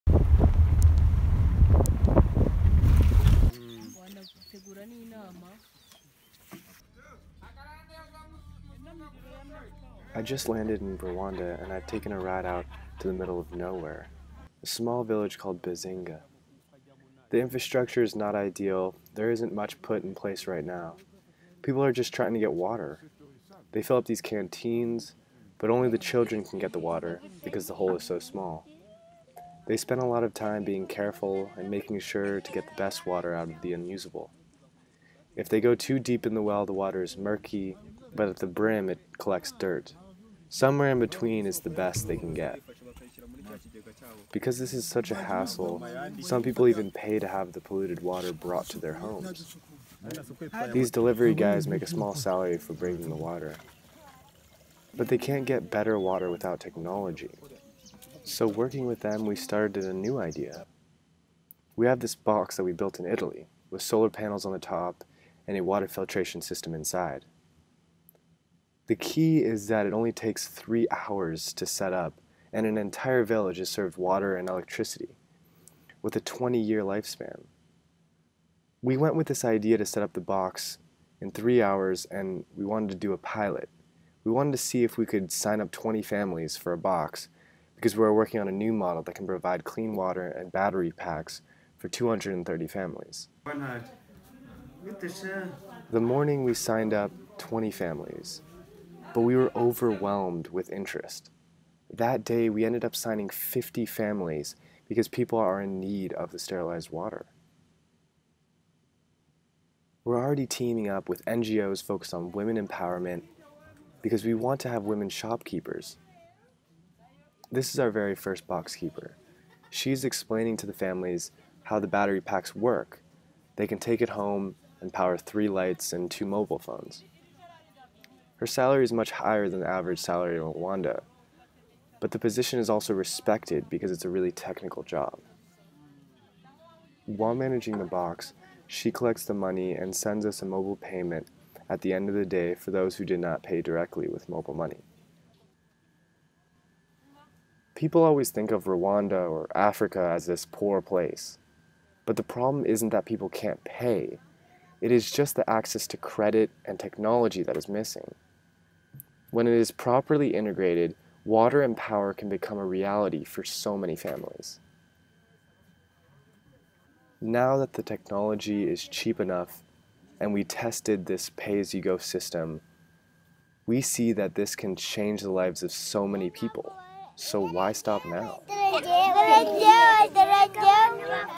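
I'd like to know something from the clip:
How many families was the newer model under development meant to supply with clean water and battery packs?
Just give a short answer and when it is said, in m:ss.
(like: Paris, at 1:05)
230, at 1:31.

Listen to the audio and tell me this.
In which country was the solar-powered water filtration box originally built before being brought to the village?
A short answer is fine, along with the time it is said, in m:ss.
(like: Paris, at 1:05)
Italy, at 1:03.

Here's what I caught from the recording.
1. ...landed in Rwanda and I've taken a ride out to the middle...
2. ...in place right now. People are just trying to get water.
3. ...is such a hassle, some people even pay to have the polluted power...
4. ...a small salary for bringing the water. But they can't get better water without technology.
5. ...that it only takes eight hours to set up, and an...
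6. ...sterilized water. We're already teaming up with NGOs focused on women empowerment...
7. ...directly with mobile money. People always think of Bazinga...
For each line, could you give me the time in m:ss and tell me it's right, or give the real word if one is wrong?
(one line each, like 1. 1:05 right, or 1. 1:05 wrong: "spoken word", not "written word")
1. 0:10 right
2. 0:20 right
3. 0:44 wrong: "water", not "power"
4. 0:51 right
5. 1:09 wrong: "three", not "eight"
6. 1:46 right
7. 2:23 wrong: "Rwanda", not "Bazinga".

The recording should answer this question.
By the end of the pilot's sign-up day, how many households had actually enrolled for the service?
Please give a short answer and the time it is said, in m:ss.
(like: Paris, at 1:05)
50, at 1:43.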